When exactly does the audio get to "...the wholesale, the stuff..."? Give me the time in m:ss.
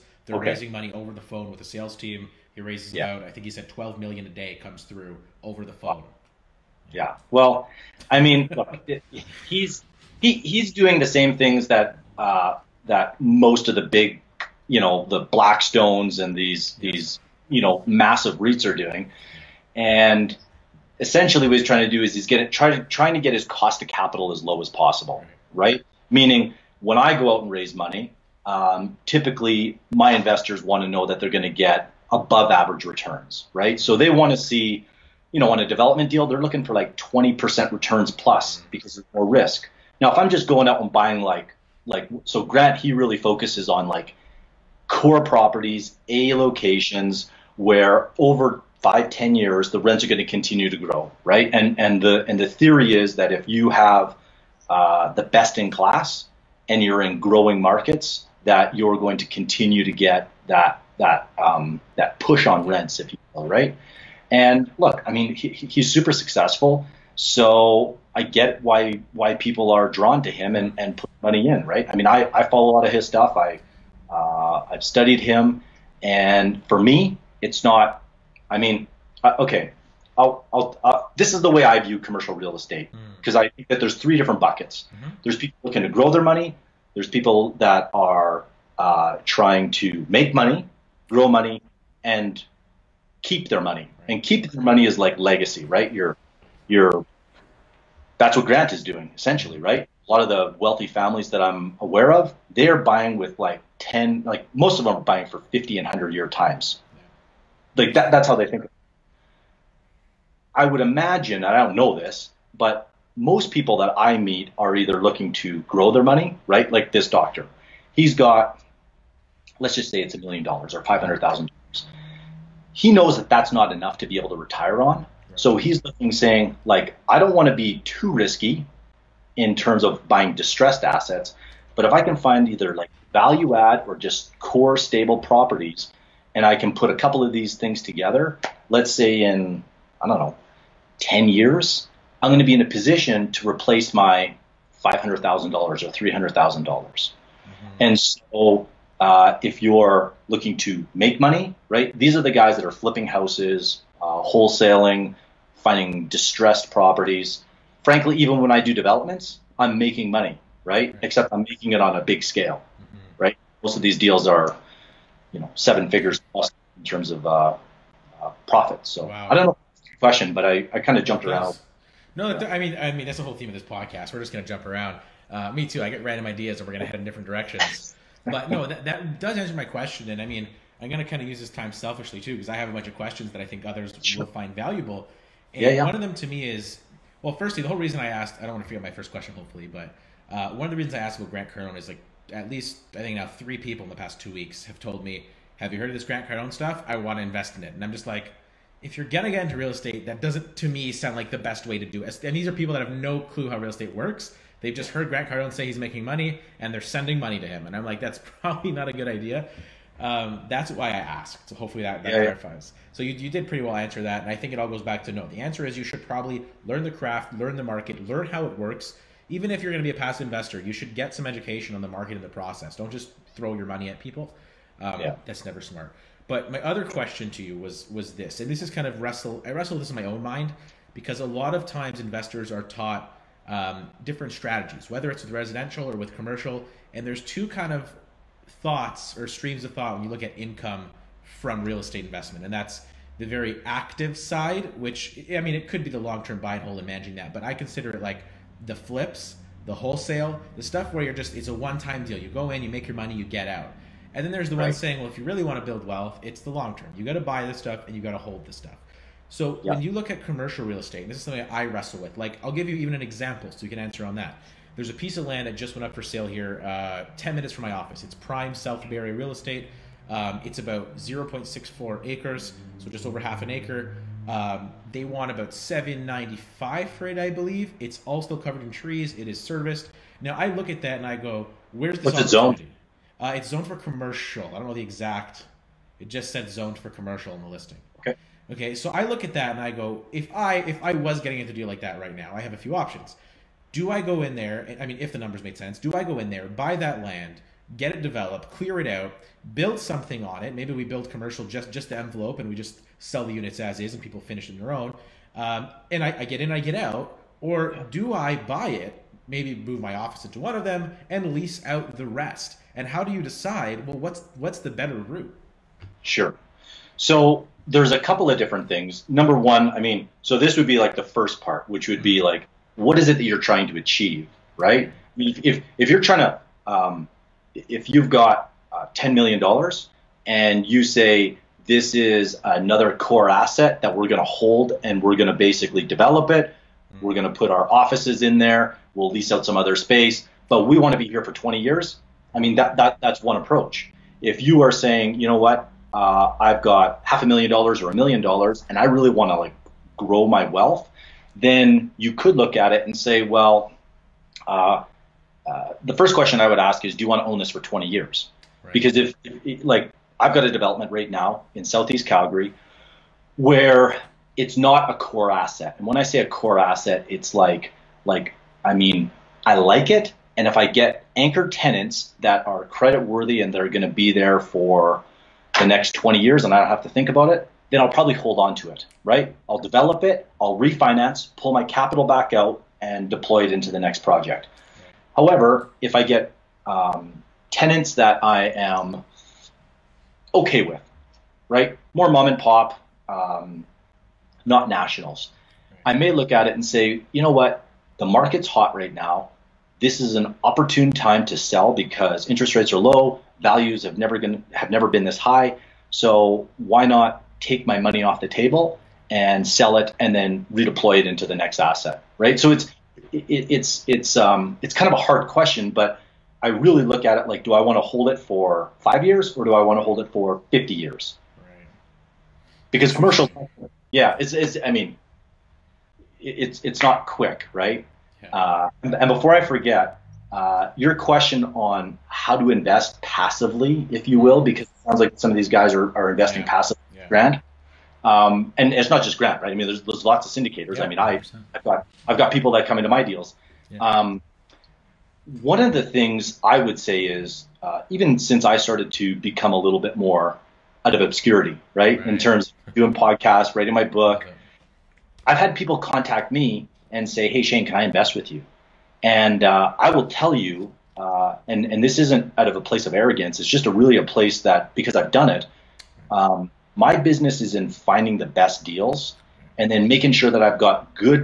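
4:09.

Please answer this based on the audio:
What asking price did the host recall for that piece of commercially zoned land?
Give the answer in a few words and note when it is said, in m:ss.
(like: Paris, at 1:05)
795, at 4:35.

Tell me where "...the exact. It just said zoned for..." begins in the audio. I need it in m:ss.
4:44.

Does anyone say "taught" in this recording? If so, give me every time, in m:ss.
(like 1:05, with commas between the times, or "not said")
3:52.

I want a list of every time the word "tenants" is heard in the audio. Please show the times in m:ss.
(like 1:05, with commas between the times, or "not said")
6:11, 6:27.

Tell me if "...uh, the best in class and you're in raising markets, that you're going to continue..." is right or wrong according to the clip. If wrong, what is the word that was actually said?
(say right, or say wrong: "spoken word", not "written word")
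wrong: "growing", not "raising".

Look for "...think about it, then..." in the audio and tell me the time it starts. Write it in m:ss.
6:16.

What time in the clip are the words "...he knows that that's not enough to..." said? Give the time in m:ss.
2:02.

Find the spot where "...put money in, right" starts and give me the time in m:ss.
1:10.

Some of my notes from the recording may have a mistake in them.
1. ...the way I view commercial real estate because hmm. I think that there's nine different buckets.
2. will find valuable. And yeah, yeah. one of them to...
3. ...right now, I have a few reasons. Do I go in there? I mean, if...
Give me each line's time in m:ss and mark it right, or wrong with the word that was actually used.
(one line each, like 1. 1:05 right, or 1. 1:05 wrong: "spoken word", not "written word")
1. 1:21 wrong: "three", not "nine"
2. 3:04 right
3. 4:51 wrong: "options", not "reasons".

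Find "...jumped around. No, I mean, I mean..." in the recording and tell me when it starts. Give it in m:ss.
2:51.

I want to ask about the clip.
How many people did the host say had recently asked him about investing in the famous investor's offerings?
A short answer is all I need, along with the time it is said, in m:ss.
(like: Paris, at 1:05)
3, at 3:13.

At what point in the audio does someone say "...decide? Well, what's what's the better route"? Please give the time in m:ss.
5:13.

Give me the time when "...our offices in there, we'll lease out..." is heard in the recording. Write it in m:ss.
5:37.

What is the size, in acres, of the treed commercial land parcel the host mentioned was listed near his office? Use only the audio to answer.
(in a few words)
0.64 acres.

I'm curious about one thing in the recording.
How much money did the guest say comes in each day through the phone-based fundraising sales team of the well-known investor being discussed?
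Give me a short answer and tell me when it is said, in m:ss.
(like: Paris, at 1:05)
12 million, at 0:03.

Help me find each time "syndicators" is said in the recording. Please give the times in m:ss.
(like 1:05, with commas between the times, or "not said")
7:20.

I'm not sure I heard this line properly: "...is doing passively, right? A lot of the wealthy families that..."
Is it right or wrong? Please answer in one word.
wrong.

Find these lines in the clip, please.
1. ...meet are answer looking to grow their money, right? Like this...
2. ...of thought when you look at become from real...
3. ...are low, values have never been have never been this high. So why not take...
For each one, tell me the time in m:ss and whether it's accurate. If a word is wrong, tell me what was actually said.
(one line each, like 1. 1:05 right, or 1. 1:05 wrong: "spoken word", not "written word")
1. 1:54 wrong: "either", not "answer"
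2. 3:59 wrong: "income", not "become"
3. 6:42 right.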